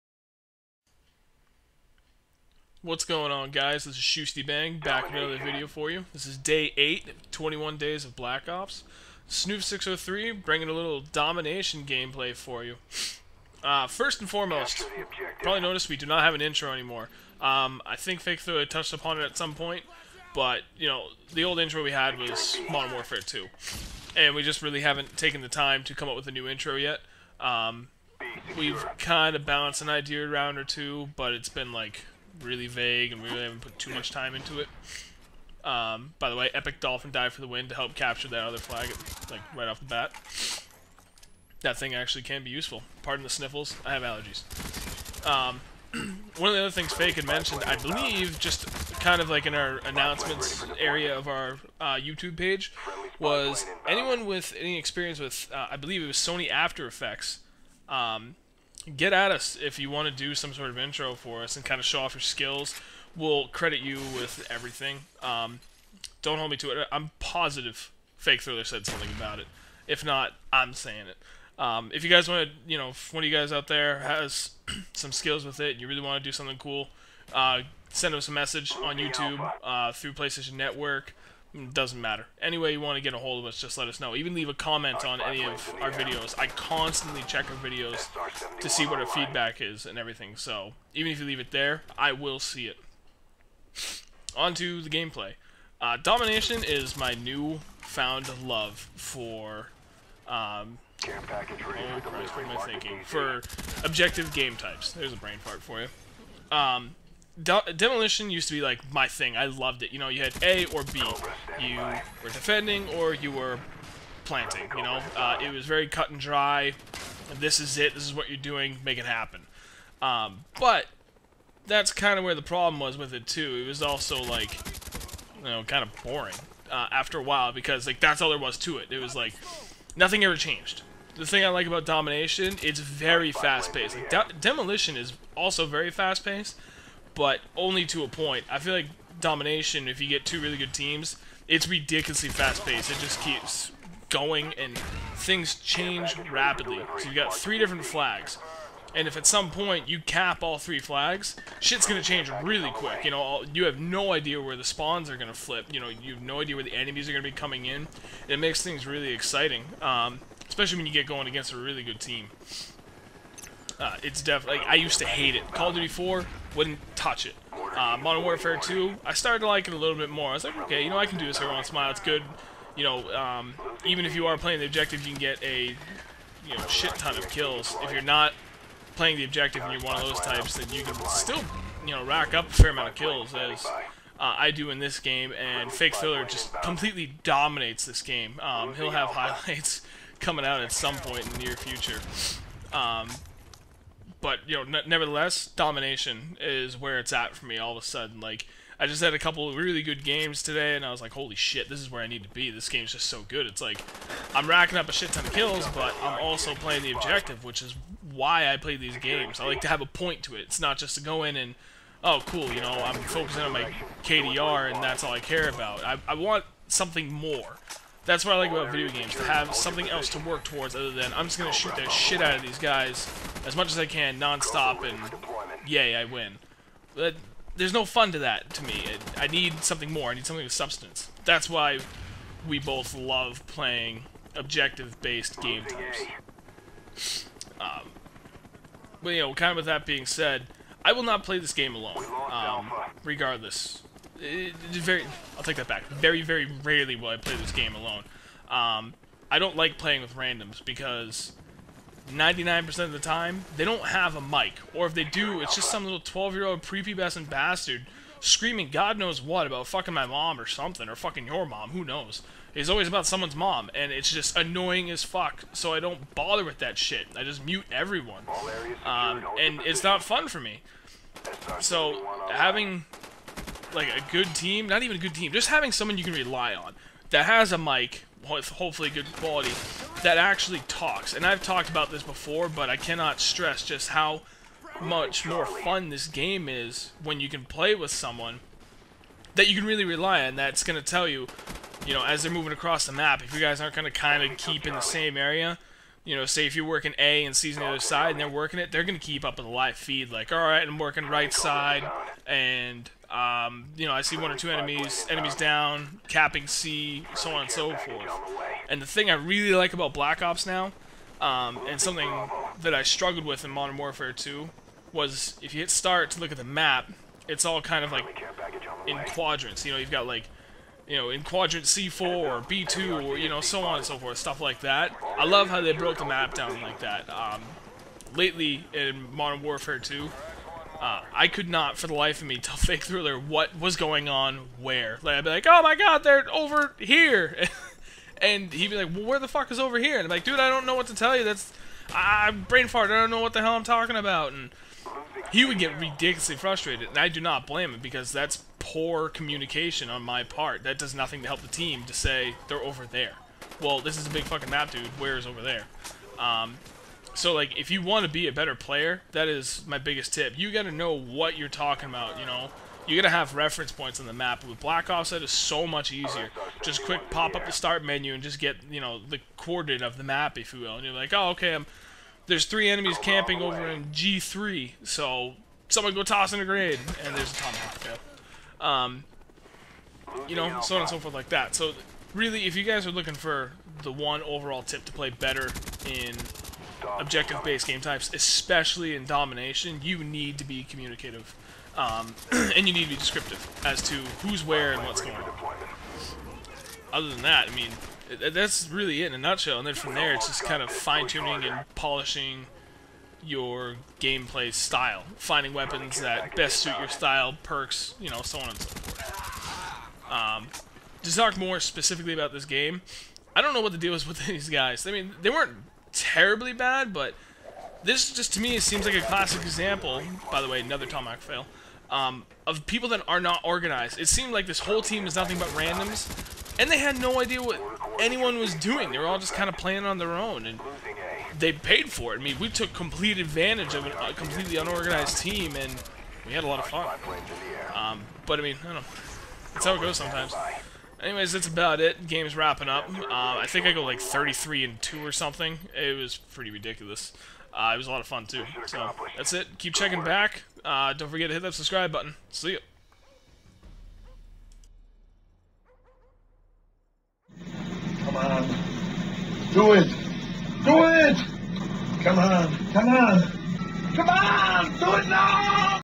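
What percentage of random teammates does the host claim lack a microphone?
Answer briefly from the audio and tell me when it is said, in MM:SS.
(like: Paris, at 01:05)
99%, at 04:12.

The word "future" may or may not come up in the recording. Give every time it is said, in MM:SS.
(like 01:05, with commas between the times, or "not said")
03:11.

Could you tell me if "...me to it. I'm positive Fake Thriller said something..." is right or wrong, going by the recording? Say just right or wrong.
right.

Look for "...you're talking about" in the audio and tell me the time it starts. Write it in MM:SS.
06:01.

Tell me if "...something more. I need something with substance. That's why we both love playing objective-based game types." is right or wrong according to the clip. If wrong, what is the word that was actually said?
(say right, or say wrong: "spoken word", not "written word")
right.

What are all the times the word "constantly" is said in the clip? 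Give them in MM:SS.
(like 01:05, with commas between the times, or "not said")
01:26.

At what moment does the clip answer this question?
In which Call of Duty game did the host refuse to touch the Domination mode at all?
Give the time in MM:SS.
02:45.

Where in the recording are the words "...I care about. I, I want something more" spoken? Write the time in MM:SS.
03:35.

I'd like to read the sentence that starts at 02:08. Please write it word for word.
It was like nothing ever changed.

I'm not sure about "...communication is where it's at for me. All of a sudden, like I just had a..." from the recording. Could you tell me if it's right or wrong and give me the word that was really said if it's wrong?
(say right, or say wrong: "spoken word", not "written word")
wrong: "domination", not "communication".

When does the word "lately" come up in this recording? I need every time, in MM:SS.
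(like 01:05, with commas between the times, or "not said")
05:28.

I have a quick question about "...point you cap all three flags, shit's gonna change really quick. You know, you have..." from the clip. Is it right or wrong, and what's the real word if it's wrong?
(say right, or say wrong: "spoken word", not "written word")
right.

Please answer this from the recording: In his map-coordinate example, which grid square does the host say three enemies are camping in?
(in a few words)
G3.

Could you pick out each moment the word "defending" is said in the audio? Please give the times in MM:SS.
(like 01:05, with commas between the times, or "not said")
01:52.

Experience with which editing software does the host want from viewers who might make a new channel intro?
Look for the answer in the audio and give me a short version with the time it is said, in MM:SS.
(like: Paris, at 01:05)
Sony After Effects, at 00:56.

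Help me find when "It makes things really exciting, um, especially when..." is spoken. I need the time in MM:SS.
02:38.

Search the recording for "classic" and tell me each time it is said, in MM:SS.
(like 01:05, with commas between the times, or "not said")
06:59.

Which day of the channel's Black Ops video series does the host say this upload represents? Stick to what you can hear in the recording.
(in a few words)
Day 8.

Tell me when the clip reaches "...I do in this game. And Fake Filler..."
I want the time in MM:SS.
03:04.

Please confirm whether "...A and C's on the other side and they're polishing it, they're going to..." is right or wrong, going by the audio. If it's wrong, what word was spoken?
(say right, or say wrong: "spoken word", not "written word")
wrong: "working", not "polishing".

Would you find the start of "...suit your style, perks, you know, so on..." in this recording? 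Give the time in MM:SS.
06:46.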